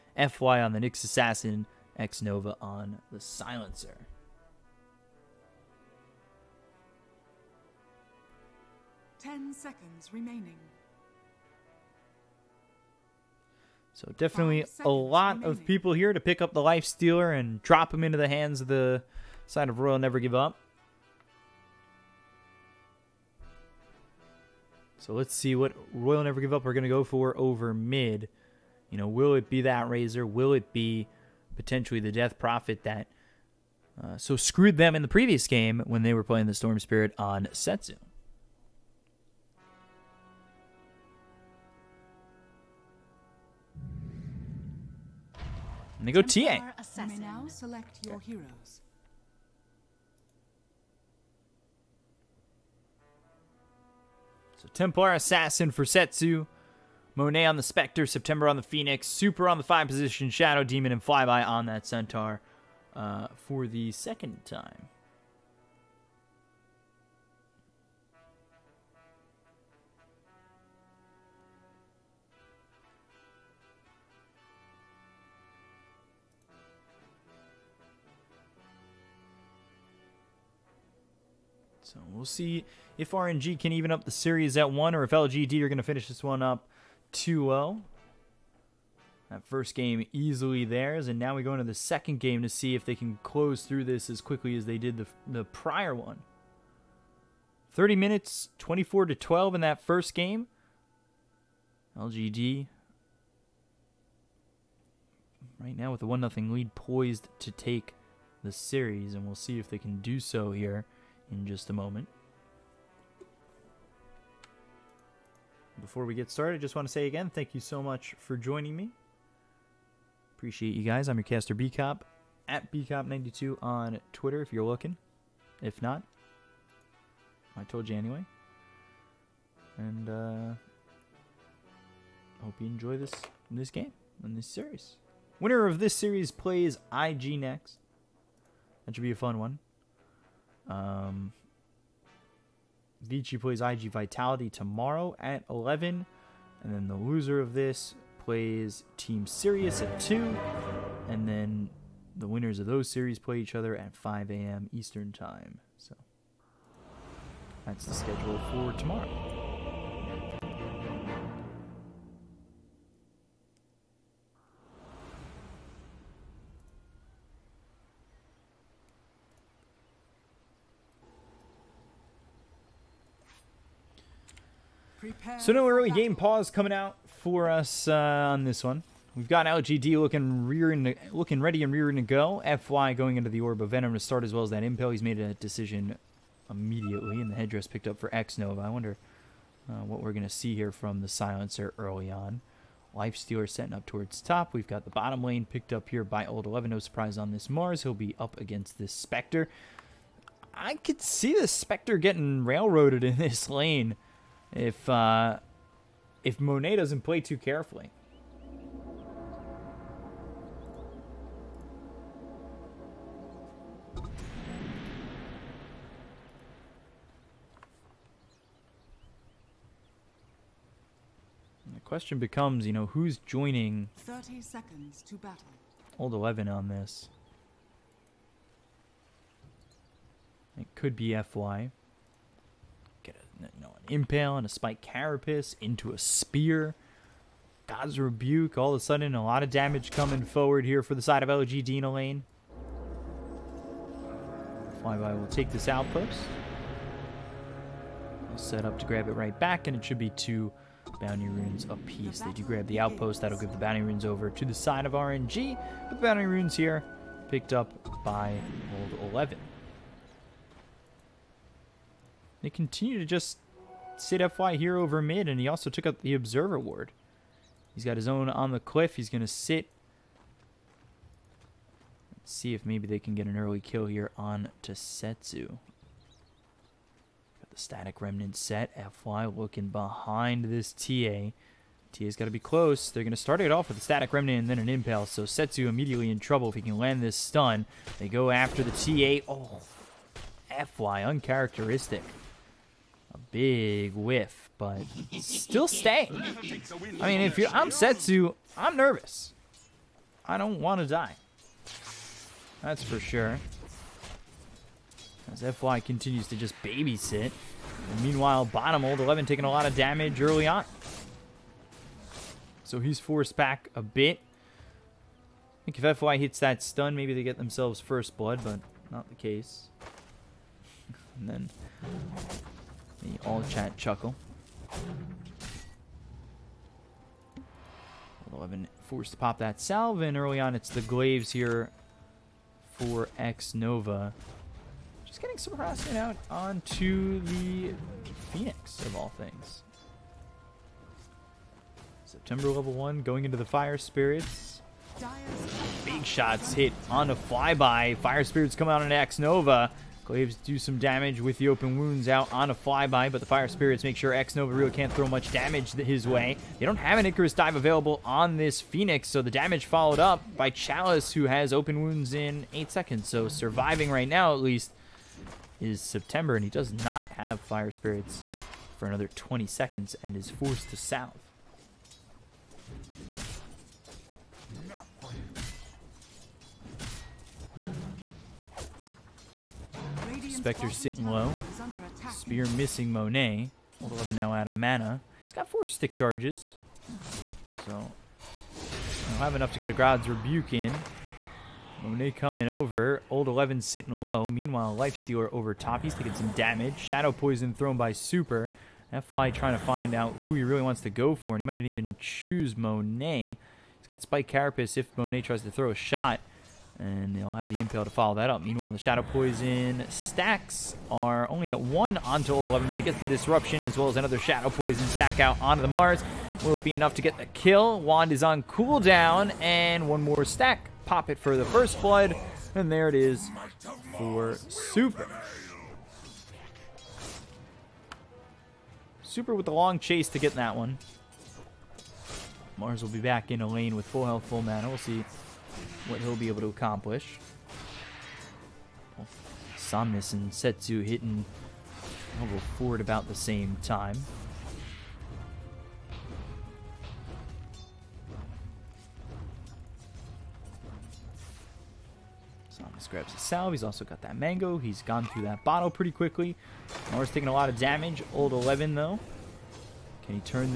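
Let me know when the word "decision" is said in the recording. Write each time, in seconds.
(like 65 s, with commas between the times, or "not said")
185 s.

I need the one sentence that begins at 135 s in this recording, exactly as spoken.
Winner of this series plays IG next.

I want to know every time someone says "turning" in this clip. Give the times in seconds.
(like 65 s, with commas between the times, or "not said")
not said.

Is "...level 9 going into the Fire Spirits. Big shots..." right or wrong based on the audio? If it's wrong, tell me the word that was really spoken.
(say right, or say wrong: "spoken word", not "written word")
wrong: "1", not "9".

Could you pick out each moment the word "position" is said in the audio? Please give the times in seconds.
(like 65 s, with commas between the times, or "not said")
59 s.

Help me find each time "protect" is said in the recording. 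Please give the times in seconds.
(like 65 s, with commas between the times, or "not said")
not said.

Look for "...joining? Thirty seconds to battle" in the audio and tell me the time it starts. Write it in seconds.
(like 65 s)
223 s.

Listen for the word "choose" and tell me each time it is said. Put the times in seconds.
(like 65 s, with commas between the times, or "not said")
401 s.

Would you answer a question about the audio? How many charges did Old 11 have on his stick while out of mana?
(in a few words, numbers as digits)
4.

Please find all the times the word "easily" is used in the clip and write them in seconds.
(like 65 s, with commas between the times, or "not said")
90 s.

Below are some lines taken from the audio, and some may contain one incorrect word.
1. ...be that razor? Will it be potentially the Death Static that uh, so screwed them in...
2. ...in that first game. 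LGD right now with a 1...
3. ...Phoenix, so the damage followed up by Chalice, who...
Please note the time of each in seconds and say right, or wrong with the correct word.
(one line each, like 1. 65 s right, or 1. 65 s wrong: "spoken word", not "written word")
1. 29 s wrong: "Prophet", not "Static"
2. 99 s right
3. 358 s right.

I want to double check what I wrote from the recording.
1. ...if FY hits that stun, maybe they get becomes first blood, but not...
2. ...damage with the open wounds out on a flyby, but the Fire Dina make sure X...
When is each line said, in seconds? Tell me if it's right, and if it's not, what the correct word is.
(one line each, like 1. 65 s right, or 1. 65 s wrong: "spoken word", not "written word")
1. 315 s wrong: "themselves", not "becomes"
2. 350 s wrong: "Spirits", not "Dina".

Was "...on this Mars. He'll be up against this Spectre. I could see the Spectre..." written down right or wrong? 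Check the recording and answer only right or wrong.
right.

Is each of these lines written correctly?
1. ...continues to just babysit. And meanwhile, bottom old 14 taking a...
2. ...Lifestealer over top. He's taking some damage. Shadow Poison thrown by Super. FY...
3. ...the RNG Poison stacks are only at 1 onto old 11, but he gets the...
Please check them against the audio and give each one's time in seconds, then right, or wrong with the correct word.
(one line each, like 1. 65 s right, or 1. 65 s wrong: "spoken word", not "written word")
1. 305 s wrong: "11", not "14"
2. 394 s right
3. 408 s wrong: "Shadow", not "RNG".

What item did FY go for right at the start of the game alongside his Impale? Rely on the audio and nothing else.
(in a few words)
Orb of Venom.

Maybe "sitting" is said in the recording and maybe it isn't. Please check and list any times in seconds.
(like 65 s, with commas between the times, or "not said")
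380 s, 393 s.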